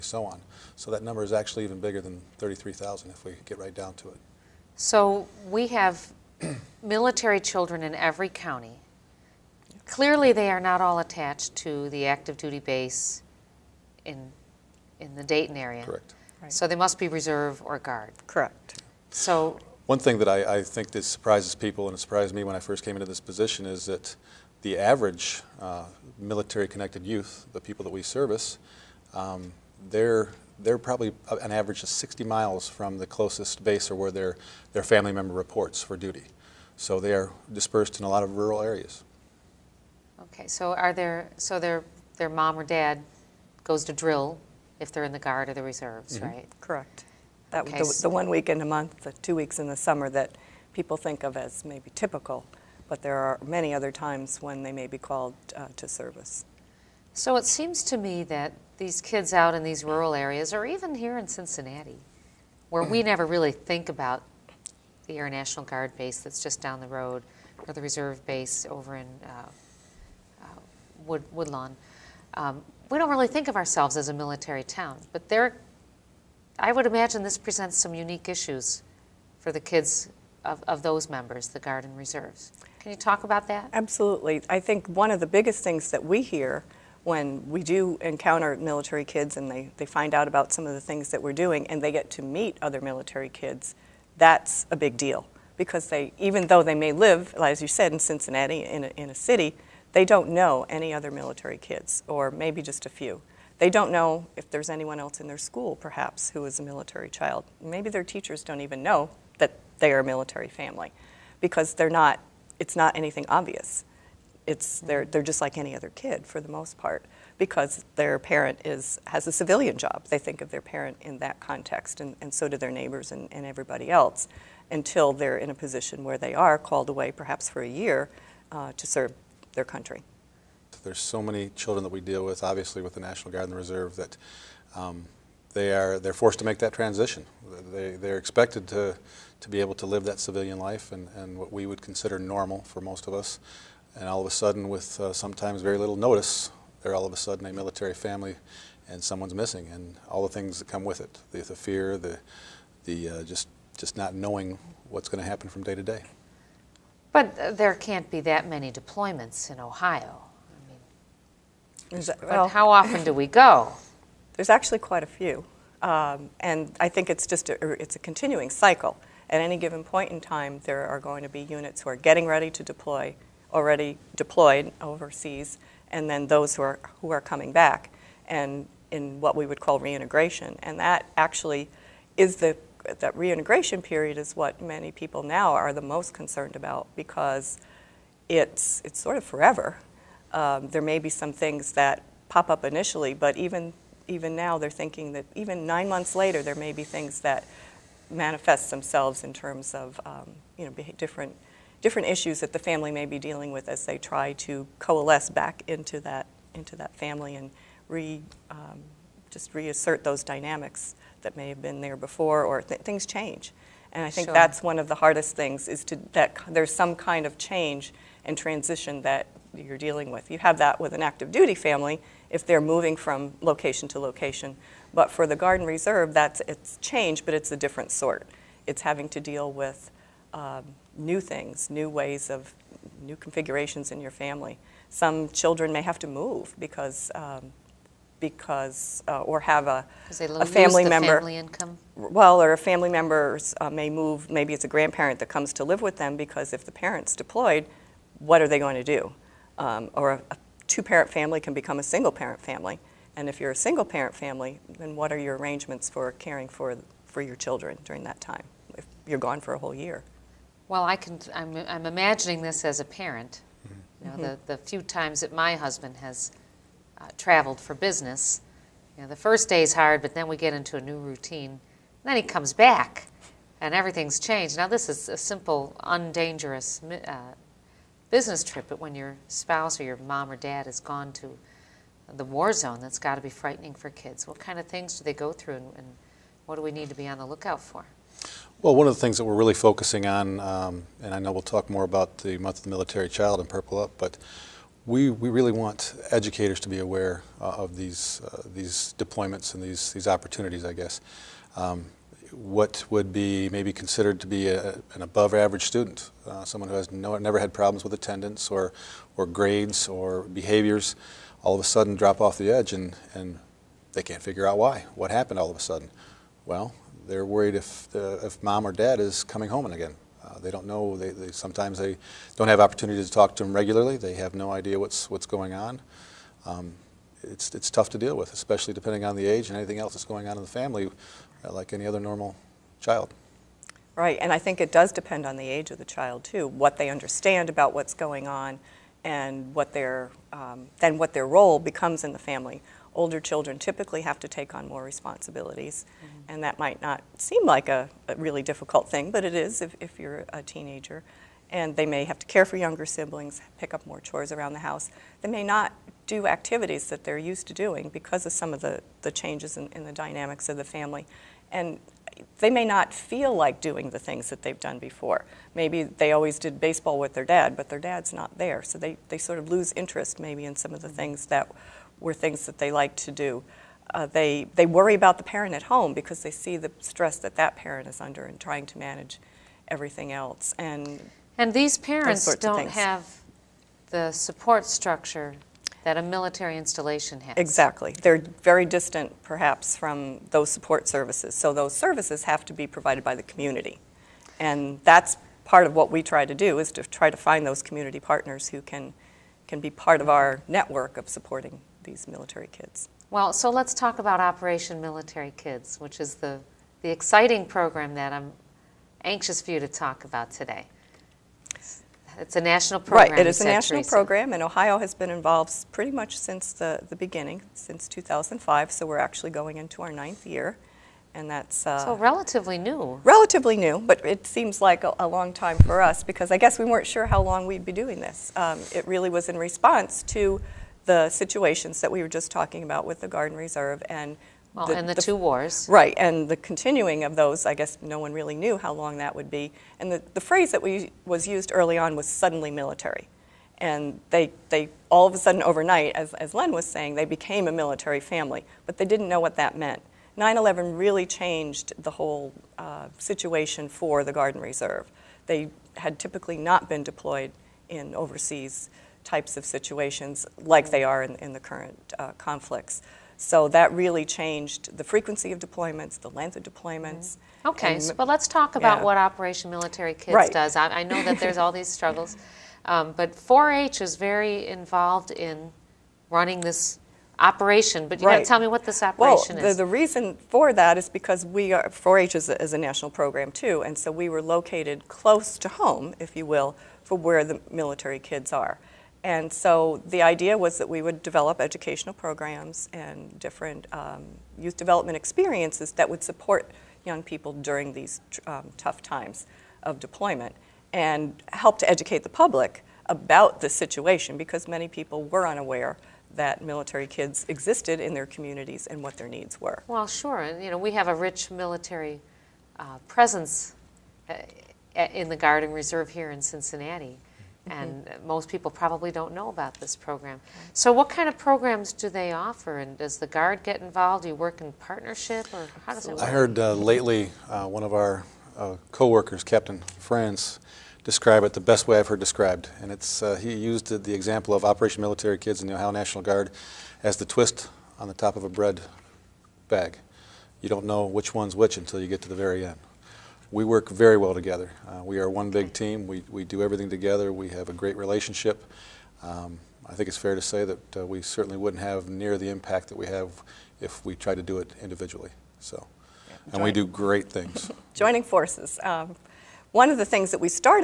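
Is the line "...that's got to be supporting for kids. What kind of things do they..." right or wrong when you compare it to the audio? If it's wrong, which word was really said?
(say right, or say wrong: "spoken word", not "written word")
wrong: "frightening", not "supporting".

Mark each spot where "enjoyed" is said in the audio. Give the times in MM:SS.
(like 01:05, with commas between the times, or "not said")
not said.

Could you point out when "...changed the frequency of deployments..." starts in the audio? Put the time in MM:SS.
07:44.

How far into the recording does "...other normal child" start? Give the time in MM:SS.
05:31.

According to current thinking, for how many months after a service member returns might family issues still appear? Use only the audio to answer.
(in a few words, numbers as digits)
nine months.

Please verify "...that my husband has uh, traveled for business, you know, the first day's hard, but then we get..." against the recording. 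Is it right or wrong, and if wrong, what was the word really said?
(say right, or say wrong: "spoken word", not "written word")
right.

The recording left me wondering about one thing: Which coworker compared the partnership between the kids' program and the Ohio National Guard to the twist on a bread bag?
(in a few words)
Captain France.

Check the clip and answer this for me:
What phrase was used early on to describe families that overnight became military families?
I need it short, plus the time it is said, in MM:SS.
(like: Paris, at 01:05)
suddenly military, at 07:22.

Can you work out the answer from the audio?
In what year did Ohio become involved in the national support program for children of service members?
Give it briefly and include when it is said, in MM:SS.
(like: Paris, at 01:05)
2005, at 06:57.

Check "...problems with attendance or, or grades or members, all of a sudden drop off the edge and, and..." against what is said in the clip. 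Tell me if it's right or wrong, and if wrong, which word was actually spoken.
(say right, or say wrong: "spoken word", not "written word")
wrong: "behaviors", not "members".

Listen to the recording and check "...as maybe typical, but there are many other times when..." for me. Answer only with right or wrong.
right.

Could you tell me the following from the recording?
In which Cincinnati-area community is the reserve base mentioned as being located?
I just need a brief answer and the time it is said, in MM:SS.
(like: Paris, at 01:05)
Woodlawn, at 01:11.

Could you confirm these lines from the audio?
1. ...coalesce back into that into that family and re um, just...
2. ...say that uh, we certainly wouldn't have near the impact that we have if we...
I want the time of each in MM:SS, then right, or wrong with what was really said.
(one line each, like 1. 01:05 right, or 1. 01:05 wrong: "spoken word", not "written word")
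1. 03:24 right
2. 09:10 right.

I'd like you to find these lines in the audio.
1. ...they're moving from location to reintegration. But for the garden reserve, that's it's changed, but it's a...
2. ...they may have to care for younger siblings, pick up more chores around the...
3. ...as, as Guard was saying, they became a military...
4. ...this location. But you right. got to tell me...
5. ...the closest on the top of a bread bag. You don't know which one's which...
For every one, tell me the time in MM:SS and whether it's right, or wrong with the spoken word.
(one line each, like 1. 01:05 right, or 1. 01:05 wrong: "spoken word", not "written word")
1. 03:42 wrong: "location", not "reintegration"
2. 05:51 right
3. 07:25 wrong: "Len", not "Guard"
4. 07:56 wrong: "operation", not "location"
5. 08:56 wrong: "twist", not "closest".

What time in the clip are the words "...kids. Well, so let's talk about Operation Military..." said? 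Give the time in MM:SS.
06:42.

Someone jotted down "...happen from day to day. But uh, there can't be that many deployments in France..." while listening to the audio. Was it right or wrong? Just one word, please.
wrong.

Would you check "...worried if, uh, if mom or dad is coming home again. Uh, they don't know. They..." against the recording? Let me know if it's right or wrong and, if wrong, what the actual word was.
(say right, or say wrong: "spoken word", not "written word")
right.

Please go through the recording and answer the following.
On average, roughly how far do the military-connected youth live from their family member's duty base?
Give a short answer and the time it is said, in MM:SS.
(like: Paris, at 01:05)
60 miles, at 00:31.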